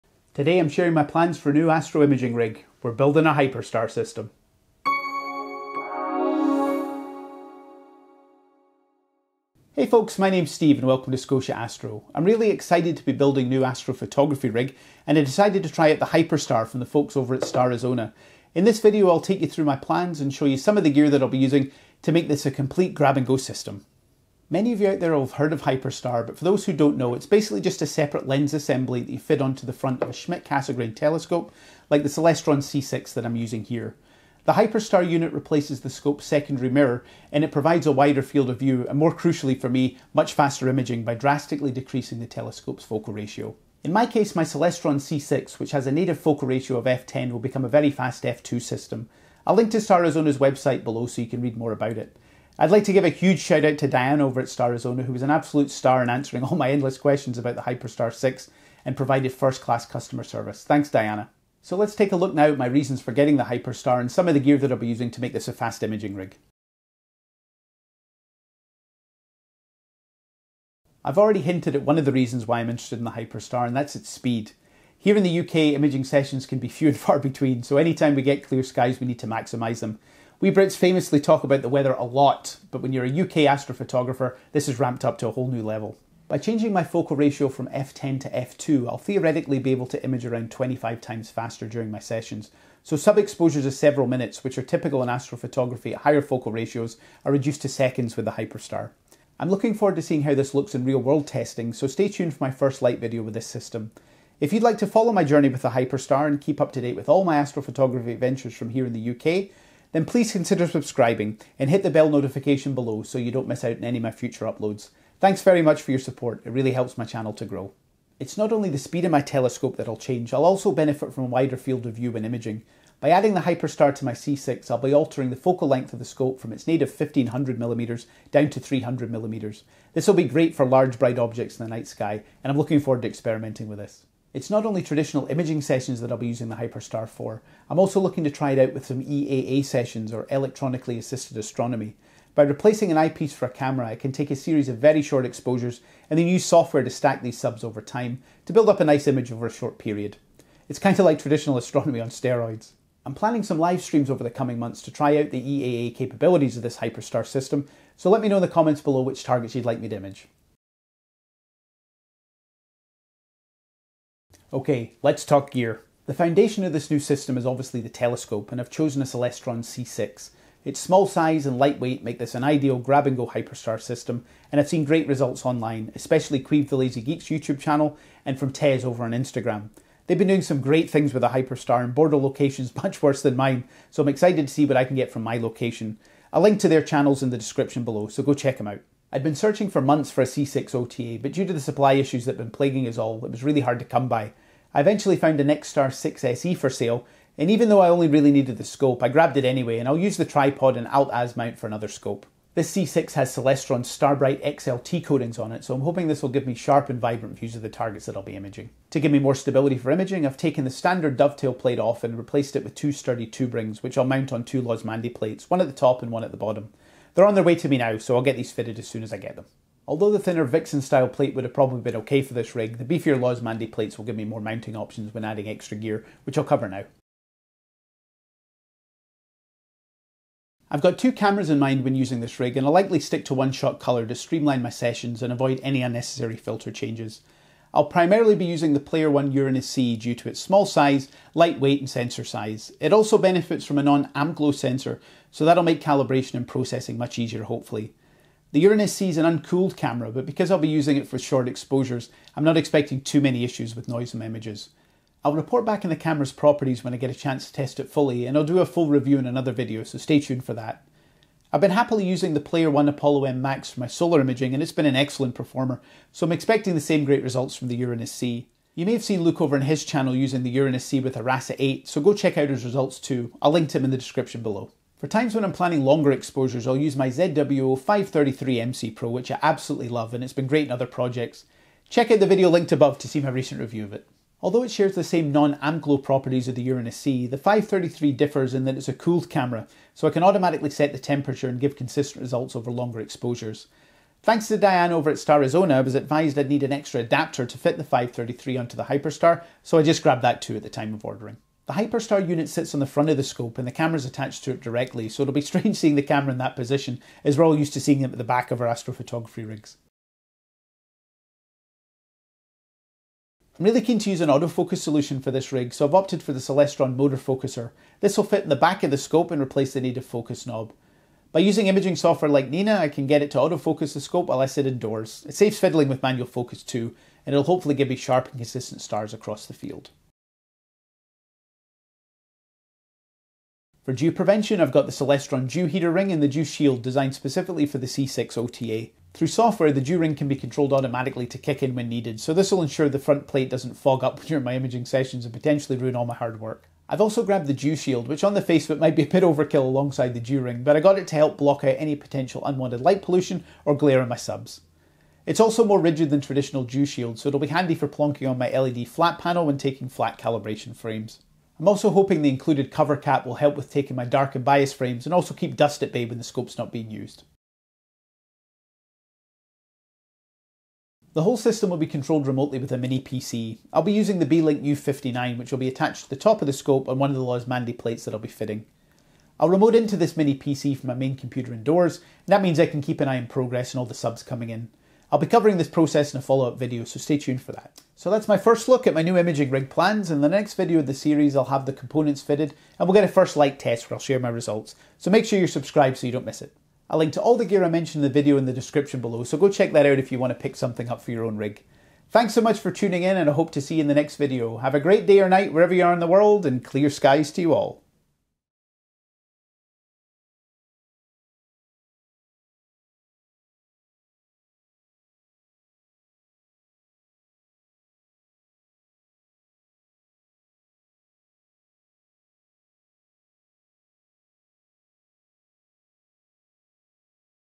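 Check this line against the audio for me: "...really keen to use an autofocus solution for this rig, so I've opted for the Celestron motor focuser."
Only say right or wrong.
right.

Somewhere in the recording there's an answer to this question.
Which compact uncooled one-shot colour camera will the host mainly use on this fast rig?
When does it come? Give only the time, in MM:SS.
03:58.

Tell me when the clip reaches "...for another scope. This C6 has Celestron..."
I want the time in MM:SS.
03:21.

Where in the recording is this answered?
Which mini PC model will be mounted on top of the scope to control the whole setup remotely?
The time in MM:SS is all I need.
06:14.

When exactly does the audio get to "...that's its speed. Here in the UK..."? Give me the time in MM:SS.
01:13.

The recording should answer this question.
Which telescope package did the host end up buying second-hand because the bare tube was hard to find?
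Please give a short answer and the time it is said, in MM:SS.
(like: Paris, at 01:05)
Nexstar 6 SE, at 03:15.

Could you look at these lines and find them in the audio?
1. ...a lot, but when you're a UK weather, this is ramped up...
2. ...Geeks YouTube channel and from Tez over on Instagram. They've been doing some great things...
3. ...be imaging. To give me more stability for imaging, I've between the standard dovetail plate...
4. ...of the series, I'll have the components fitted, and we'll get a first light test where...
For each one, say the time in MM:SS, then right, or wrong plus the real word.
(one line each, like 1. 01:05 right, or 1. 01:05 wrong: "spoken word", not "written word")
1. 01:21 wrong: "astrophotographer", not "weather"
2. 02:57 right
3. 03:28 wrong: "taken", not "between"
4. 06:30 right.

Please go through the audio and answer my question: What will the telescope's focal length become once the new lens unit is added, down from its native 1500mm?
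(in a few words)
300mm.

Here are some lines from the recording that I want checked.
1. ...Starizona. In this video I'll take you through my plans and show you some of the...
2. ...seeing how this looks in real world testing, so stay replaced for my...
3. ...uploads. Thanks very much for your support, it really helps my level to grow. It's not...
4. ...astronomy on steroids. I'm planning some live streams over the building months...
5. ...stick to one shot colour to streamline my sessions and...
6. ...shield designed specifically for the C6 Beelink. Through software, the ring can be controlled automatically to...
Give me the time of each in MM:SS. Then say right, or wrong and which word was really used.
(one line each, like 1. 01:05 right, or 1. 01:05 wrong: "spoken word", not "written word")
1. 00:17 right
2. 01:40 wrong: "tuned", not "replaced"
3. 01:54 wrong: "channel", not "level"
4. 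02:31 wrong: "coming", not "building"
5. 03:53 right
6. 05:36 wrong: "OTA", not "Beelink".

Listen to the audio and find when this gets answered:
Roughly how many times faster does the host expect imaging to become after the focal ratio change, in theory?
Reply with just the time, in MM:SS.
01:30.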